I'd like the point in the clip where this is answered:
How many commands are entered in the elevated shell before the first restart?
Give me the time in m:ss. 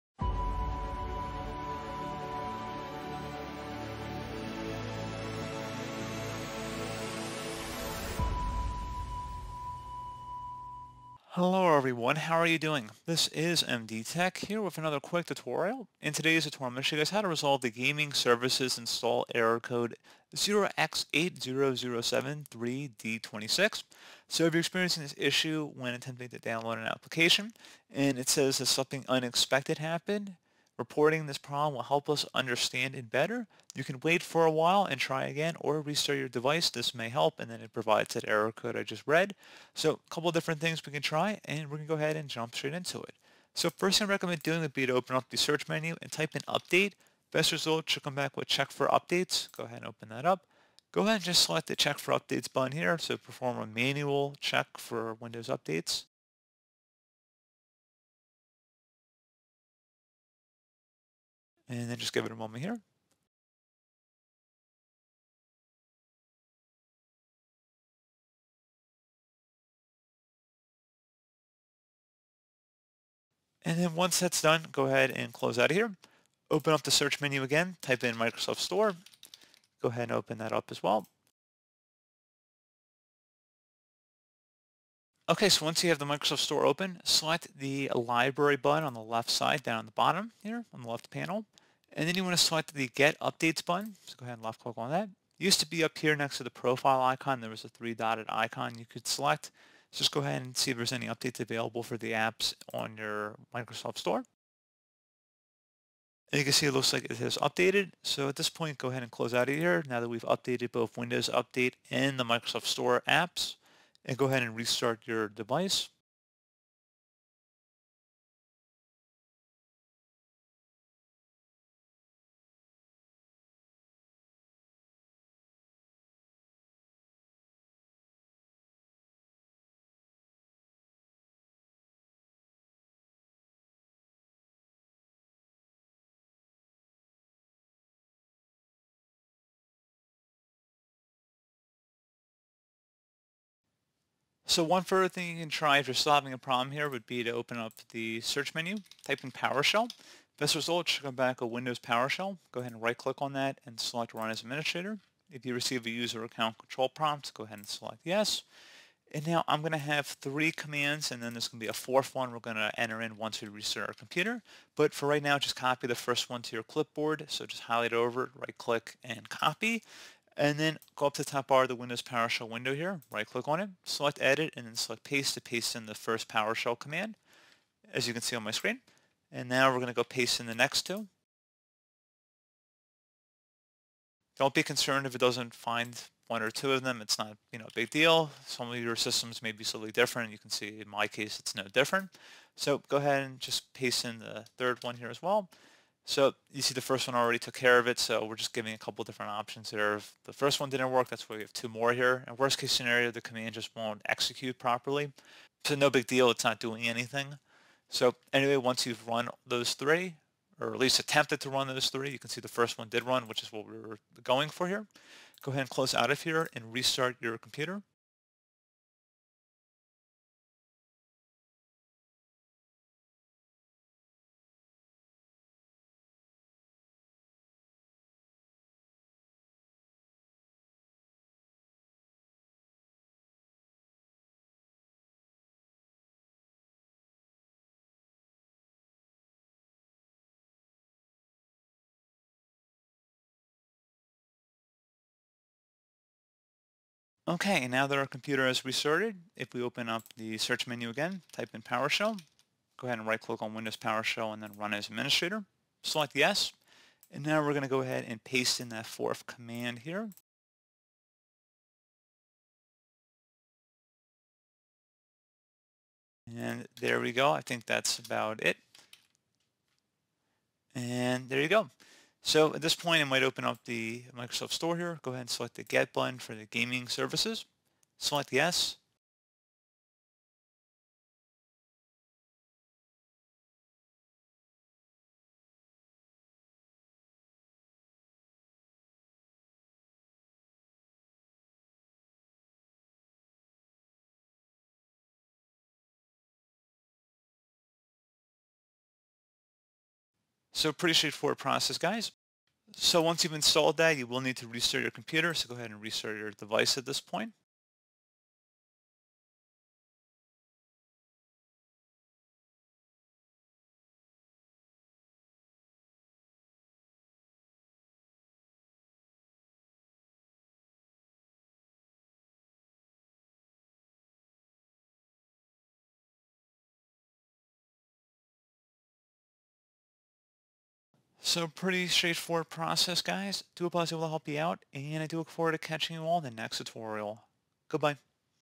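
2:40.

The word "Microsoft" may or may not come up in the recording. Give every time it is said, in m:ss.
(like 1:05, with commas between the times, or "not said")
1:18, 1:26, 1:43, 1:52, 4:34.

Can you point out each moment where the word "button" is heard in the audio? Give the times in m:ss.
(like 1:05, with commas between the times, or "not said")
0:52, 1:28, 1:33, 4:35.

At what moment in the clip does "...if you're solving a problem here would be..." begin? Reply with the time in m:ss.
2:25.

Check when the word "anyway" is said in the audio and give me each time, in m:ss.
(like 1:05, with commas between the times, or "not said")
3:28.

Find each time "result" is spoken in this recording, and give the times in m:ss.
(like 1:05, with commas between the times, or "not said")
0:47, 2:30.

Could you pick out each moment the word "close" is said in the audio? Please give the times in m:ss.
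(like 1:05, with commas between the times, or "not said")
1:15, 1:49, 3:35.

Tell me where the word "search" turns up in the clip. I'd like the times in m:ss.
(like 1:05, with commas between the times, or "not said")
0:45, 1:16, 2:28, 4:10.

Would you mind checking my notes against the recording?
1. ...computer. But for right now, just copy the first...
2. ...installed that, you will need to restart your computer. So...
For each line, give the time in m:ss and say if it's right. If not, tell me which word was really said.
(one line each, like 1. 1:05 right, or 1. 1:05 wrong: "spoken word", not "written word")
1. 2:43 right
2. 5:03 right.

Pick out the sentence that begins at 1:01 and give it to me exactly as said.
And then just give it a moment here.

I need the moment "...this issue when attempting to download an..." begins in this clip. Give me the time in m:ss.
0:25.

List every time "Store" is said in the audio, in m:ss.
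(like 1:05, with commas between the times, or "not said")
1:18, 1:26, 1:43, 1:52, 4:34.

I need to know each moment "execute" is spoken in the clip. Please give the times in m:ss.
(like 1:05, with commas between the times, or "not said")
3:24.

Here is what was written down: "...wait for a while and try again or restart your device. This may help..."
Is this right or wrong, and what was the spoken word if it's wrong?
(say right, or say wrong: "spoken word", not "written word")
right.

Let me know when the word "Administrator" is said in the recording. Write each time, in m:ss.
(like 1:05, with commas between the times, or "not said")
2:34, 4:14.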